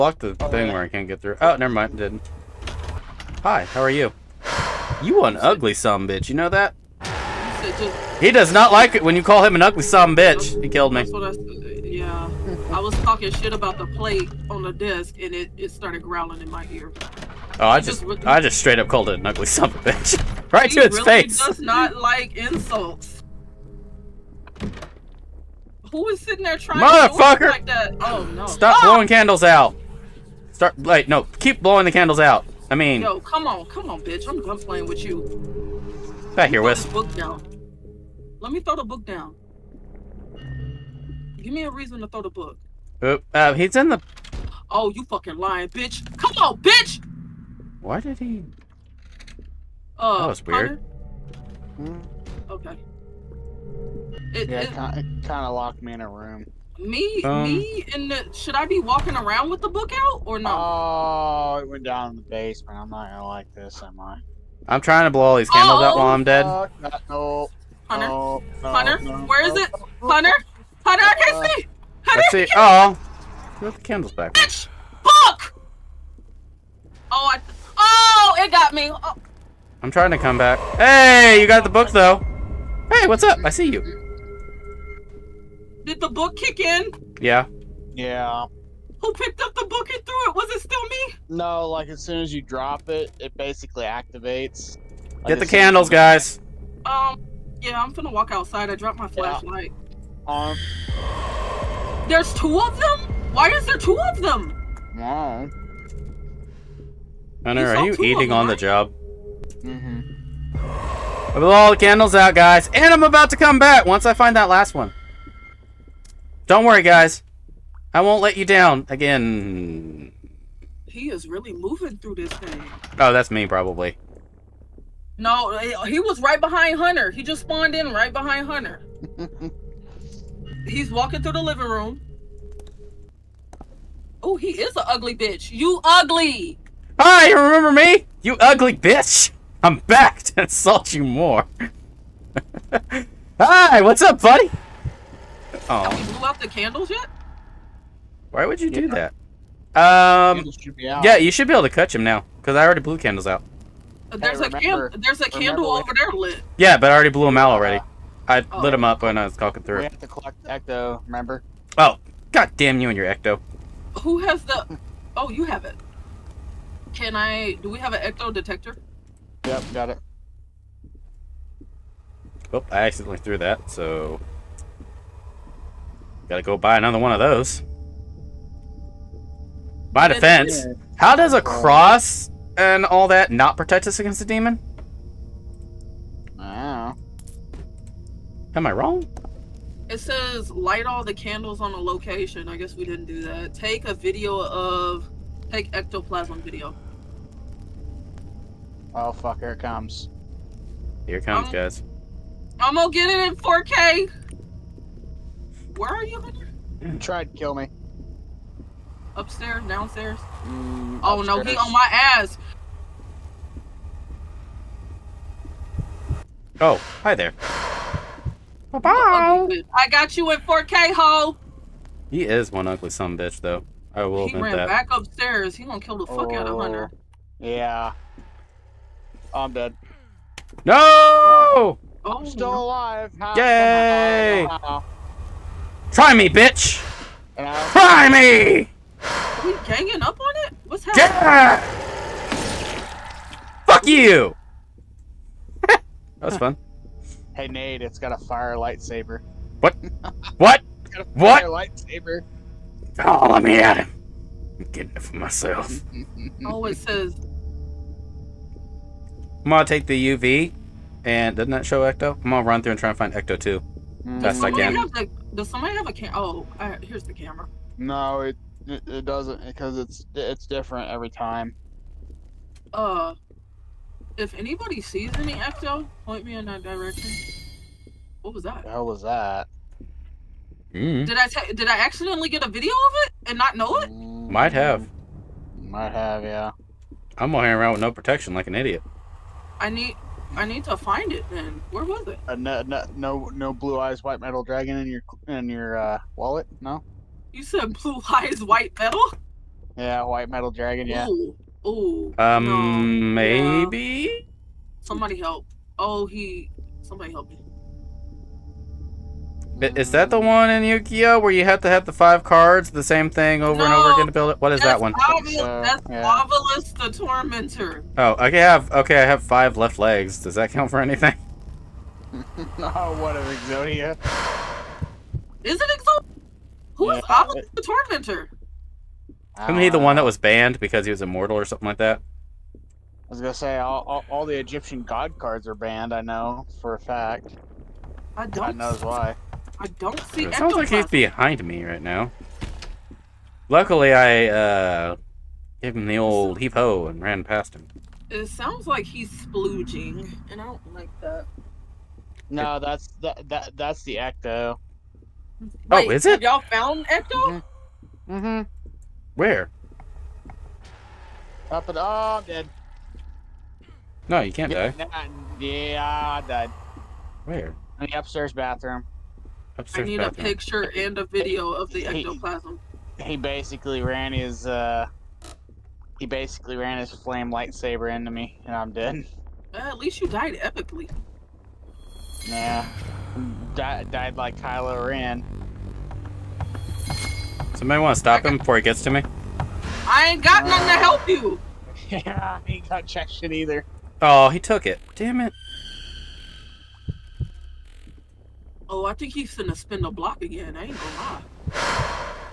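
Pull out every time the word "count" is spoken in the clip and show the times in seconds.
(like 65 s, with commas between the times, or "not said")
320 s.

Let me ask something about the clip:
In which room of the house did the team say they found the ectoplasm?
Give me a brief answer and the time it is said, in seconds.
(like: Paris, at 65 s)
upstairs bathroom, at 367 s.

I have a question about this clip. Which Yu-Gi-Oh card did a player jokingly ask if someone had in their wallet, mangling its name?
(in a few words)
Blue Eyes White Metal Dragon.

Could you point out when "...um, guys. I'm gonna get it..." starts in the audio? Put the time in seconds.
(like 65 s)
201 s.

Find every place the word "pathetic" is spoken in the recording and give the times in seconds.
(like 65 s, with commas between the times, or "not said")
not said.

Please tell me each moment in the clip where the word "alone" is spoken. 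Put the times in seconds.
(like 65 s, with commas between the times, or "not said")
not said.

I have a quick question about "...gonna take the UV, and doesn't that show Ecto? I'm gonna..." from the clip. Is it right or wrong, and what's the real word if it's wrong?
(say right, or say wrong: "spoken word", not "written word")
right.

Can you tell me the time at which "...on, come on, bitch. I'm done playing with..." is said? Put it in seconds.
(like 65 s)
33 s.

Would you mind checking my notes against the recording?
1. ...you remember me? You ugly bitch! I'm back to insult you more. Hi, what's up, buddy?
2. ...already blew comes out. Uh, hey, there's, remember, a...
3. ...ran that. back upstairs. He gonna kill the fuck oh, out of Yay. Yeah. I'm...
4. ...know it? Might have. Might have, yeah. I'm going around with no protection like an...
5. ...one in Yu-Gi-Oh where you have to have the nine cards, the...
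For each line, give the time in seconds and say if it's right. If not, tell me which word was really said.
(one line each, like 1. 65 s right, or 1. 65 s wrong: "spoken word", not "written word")
1. 137 s right
2. 152 s wrong: "candles", not "comes"
3. 224 s wrong: "Hunter", not "Yay"
4. 283 s right
5. 310 s wrong: "five", not "nine".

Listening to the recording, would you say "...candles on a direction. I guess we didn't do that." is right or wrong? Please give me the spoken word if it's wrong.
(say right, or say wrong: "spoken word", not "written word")
wrong: "location", not "direction".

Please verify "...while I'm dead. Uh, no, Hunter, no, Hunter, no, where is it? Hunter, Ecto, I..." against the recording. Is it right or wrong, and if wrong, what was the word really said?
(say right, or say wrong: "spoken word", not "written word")
wrong: "Hunter", not "Ecto".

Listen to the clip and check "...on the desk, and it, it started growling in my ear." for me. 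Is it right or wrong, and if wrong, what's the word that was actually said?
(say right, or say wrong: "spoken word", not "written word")
right.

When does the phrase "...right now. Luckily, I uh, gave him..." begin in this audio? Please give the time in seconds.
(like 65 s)
341 s.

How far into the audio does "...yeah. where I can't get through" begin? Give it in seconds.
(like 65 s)
0 s.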